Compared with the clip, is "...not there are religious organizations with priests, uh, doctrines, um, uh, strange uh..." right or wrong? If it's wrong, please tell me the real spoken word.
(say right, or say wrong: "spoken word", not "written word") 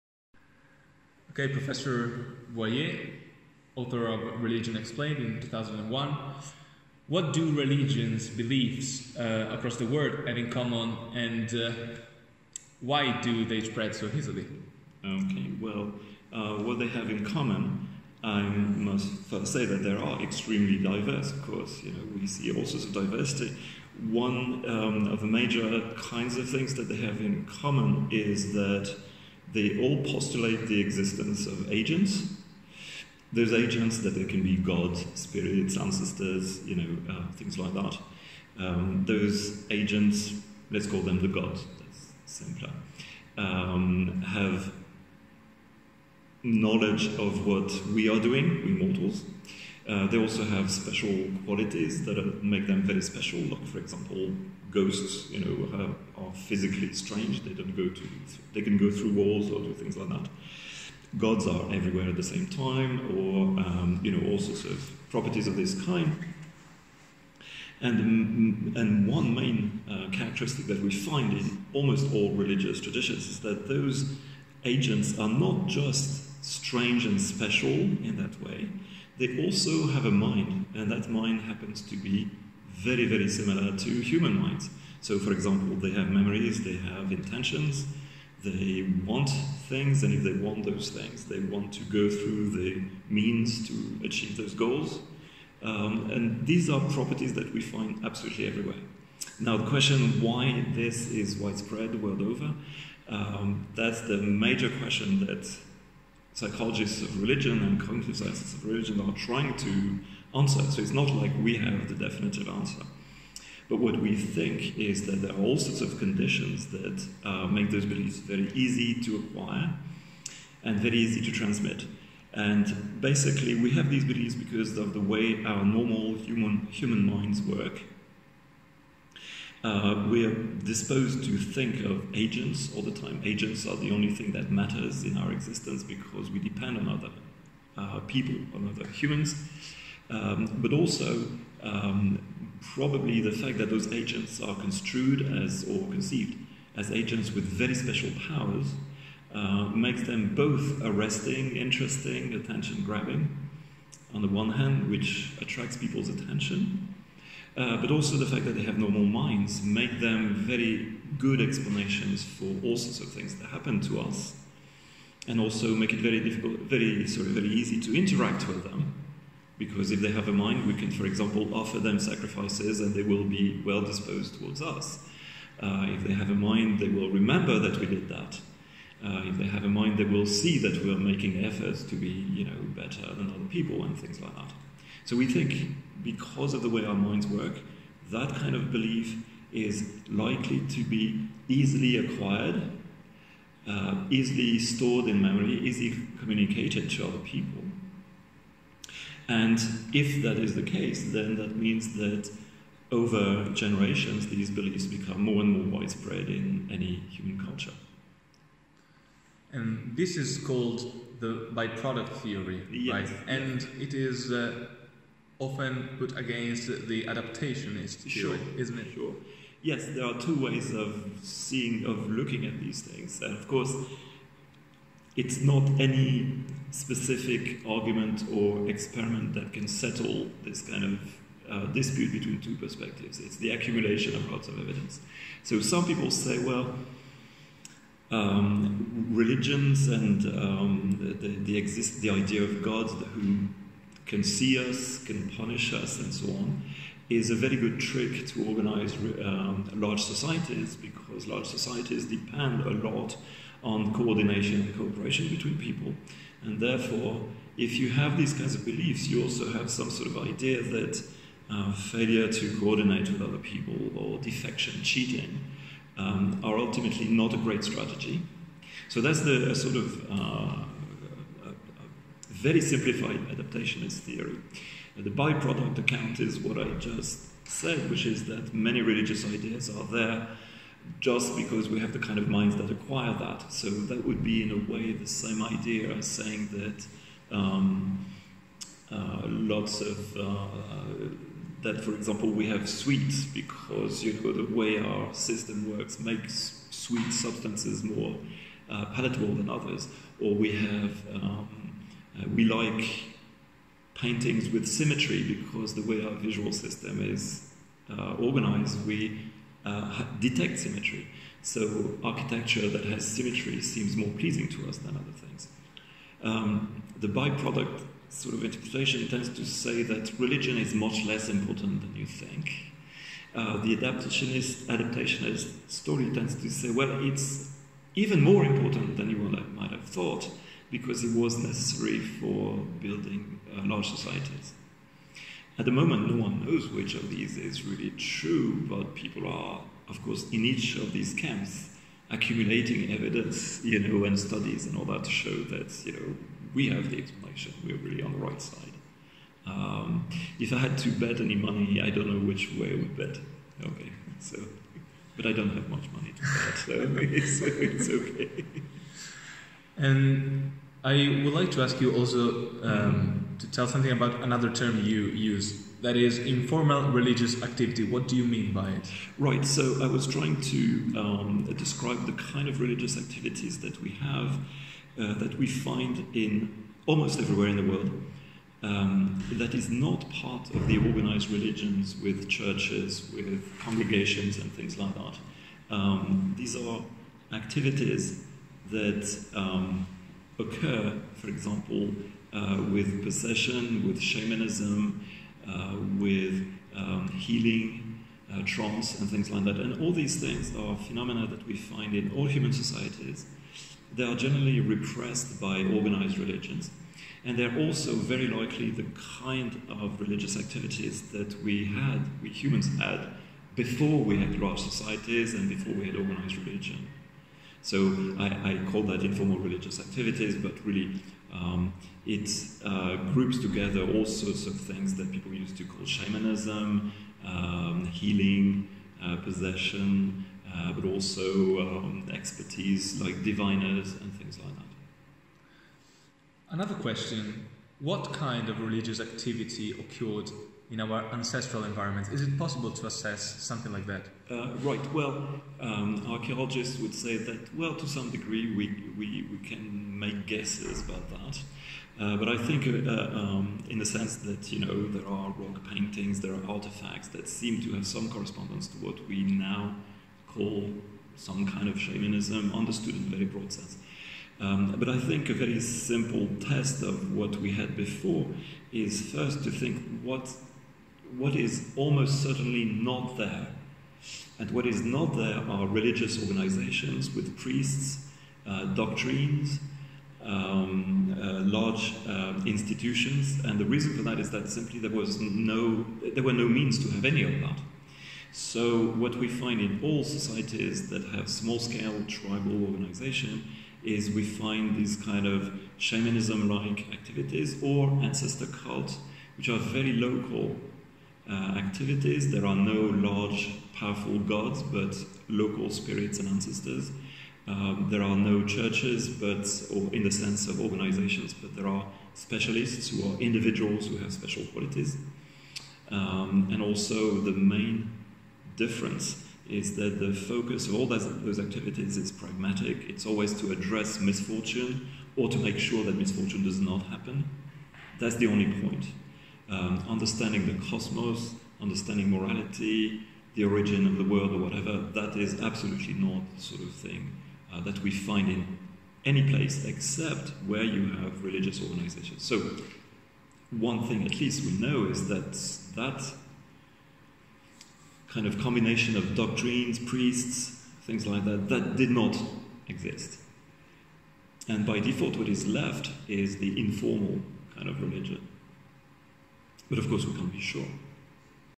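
wrong: "large", not "strange".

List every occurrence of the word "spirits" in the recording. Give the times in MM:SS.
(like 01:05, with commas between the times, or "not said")
00:35, 08:25.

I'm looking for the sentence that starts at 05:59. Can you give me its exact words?
And I would like to ask you also um, to tell something about another term you use.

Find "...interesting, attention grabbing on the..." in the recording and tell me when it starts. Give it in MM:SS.
02:31.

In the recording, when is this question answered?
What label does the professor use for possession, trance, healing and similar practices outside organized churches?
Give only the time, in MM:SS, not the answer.
06:59.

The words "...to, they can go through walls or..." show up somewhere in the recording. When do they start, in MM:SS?
00:57.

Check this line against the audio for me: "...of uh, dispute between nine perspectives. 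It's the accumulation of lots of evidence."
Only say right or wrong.
wrong.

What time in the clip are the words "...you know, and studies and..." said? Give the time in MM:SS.
05:43.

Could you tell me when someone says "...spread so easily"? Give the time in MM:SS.
00:13.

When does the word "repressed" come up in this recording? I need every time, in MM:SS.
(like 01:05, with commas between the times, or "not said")
06:44.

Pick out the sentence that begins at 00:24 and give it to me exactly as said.
One um, of the major kinds of things that they have in common is that they all postulate the existence of agents.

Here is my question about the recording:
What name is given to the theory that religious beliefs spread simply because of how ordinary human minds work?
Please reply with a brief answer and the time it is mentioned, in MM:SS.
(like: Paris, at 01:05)
byproduct theory, at 03:31.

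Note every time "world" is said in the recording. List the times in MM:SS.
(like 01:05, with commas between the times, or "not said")
00:09, 01:41, 06:17, 08:54.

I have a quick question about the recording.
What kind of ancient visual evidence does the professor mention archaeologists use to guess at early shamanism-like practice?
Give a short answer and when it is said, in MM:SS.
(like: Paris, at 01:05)
rock paintings, at 07:35.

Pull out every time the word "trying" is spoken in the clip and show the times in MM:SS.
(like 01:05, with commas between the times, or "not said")
01:49, 06:10.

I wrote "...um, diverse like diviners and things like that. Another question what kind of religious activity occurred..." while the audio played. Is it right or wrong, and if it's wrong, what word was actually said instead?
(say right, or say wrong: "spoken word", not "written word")
wrong: "expertise", not "diverse".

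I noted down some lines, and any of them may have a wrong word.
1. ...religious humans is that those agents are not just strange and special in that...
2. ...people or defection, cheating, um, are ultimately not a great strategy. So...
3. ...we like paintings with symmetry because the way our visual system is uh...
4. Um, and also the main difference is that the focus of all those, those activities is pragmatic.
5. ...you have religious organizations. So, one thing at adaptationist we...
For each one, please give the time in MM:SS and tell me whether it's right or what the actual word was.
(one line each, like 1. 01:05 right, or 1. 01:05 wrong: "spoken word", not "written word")
1. 01:12 wrong: "traditions", not "humans"
2. 04:23 right
3. 05:02 right
4. 08:35 right
5. 09:00 wrong: "least", not "adaptationist".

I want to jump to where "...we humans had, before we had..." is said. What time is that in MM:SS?
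06:52.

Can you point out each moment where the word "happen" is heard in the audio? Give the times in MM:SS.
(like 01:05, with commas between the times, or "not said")
01:21, 02:43, 08:46.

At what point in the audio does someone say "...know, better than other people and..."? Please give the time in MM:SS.
03:02.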